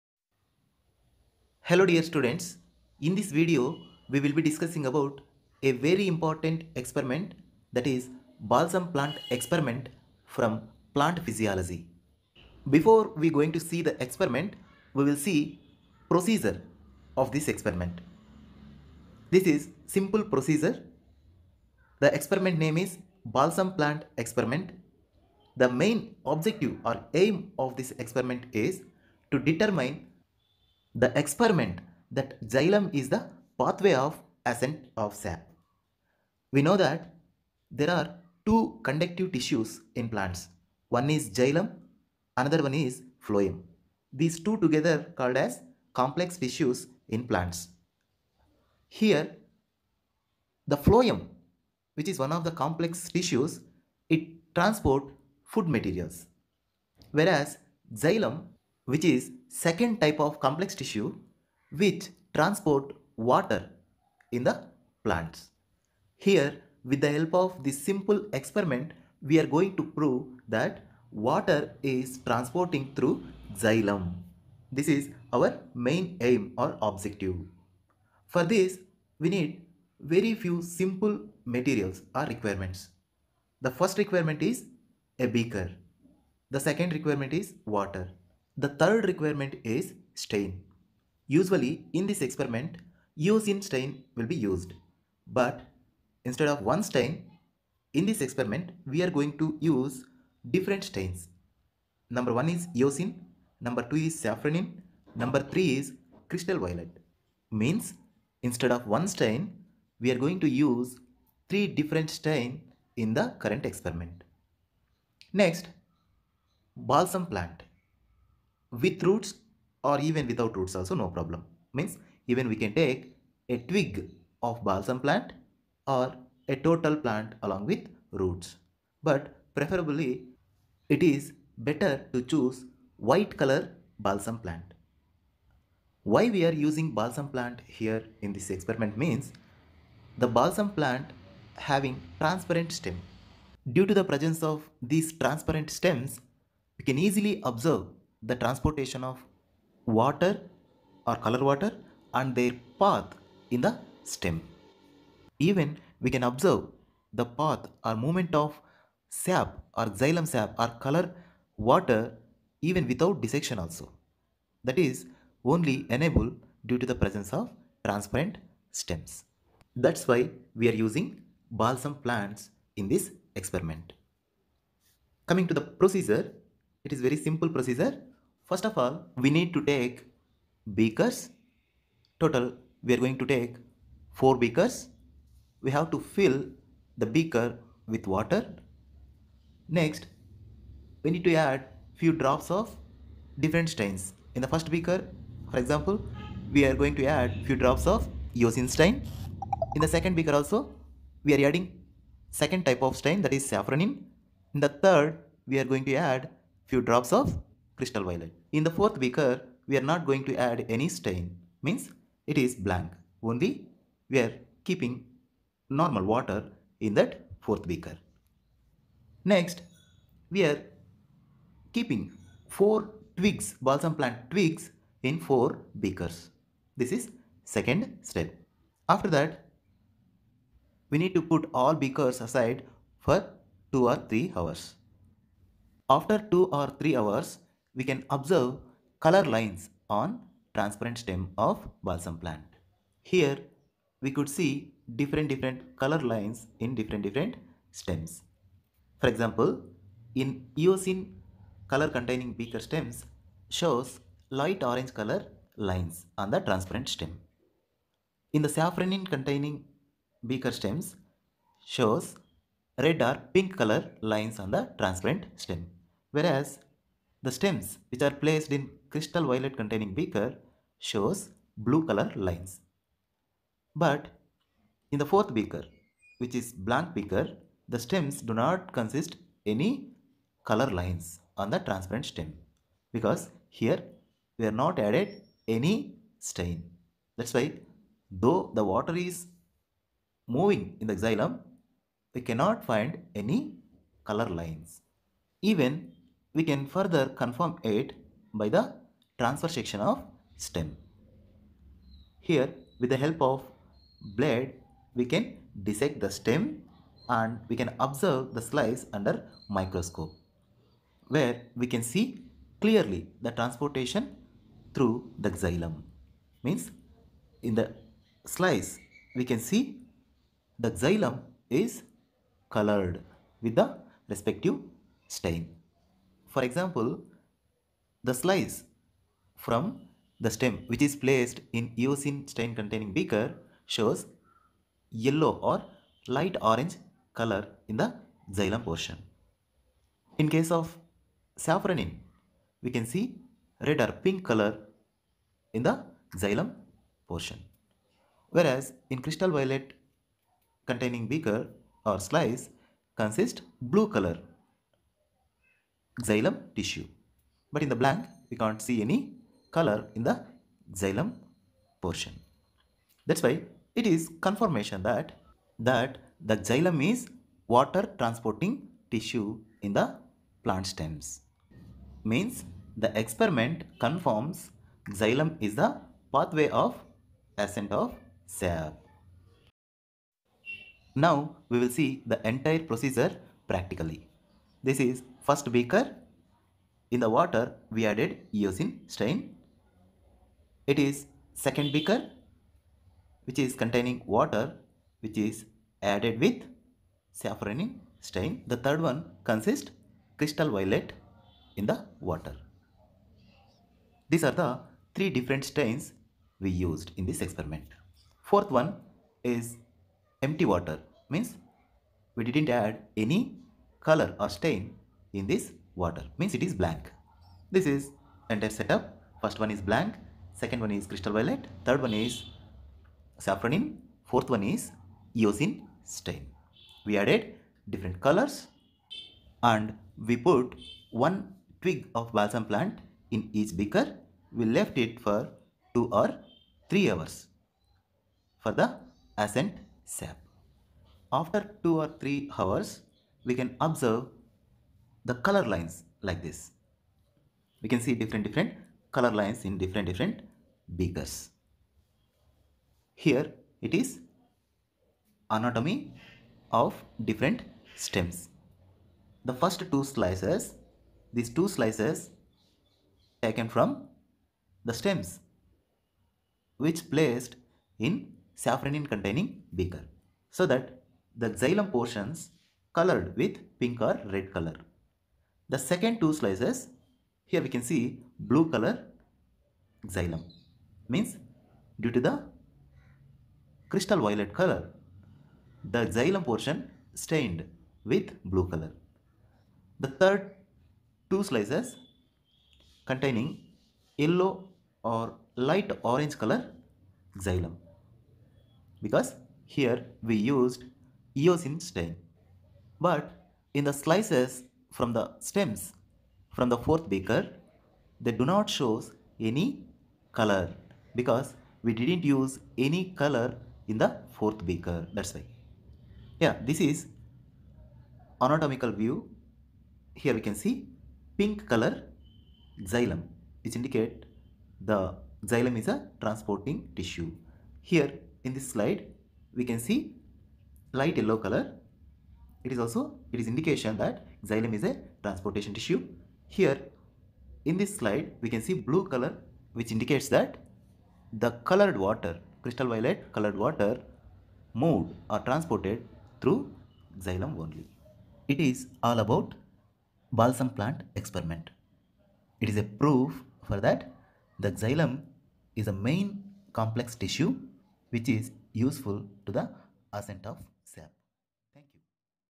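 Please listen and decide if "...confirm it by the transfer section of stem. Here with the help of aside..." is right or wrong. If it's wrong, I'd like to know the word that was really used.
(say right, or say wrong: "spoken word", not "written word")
wrong: "blade", not "aside".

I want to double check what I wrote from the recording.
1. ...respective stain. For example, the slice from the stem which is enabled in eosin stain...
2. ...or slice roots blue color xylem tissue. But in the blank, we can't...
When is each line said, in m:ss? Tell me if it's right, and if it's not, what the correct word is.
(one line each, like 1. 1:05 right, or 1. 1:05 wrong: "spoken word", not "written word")
1. 5:24 wrong: "placed", not "enabled"
2. 5:51 wrong: "consists", not "roots".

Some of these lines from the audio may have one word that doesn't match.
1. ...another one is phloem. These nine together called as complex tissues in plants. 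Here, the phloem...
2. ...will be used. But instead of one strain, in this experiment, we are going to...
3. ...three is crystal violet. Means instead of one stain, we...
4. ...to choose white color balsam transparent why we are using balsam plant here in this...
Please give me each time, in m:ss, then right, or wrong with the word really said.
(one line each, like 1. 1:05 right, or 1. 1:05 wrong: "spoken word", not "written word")
1. 0:42 wrong: "two", not "nine"
2. 1:34 wrong: "stain", not "strain"
3. 1:45 right
4. 2:12 wrong: "plant", not "transparent".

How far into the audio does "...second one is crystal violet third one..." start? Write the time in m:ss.
7:00.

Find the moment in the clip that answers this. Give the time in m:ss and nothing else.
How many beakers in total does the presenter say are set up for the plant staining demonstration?
3:04.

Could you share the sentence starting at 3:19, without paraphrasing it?
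In the second beaker also, we are adding second type of strain that is safranin.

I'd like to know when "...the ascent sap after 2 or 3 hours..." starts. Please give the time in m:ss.
7:18.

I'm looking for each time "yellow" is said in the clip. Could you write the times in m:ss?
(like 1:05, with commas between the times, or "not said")
5:35, 8:14, 8:50.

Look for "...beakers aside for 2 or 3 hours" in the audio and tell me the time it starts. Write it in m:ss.
3:51.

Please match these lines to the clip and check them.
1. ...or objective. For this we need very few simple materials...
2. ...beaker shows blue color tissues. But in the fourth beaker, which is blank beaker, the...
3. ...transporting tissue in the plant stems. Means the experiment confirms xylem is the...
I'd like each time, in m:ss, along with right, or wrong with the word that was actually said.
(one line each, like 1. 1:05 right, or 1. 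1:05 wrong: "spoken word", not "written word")
1. 1:16 right
2. 4:29 wrong: "lines", not "tissues"
3. 6:07 right.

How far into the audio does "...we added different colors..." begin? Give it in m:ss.
7:06.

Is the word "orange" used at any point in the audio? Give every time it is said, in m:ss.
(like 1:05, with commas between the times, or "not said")
4:14, 5:36, 8:15.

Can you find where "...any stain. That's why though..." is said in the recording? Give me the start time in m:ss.
4:45.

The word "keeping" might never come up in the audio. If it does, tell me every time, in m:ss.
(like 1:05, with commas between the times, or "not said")
3:34, 3:41.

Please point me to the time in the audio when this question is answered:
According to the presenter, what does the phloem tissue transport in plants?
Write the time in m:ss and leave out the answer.
0:55.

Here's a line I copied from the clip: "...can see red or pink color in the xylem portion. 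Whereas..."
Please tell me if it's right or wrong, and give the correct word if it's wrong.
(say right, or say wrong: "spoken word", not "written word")
right.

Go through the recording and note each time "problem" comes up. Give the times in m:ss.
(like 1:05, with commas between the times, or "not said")
2:01.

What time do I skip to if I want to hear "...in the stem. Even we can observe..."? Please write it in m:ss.
2:33.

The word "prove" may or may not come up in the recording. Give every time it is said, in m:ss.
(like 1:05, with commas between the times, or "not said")
1:09.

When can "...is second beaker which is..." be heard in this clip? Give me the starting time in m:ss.
6:30.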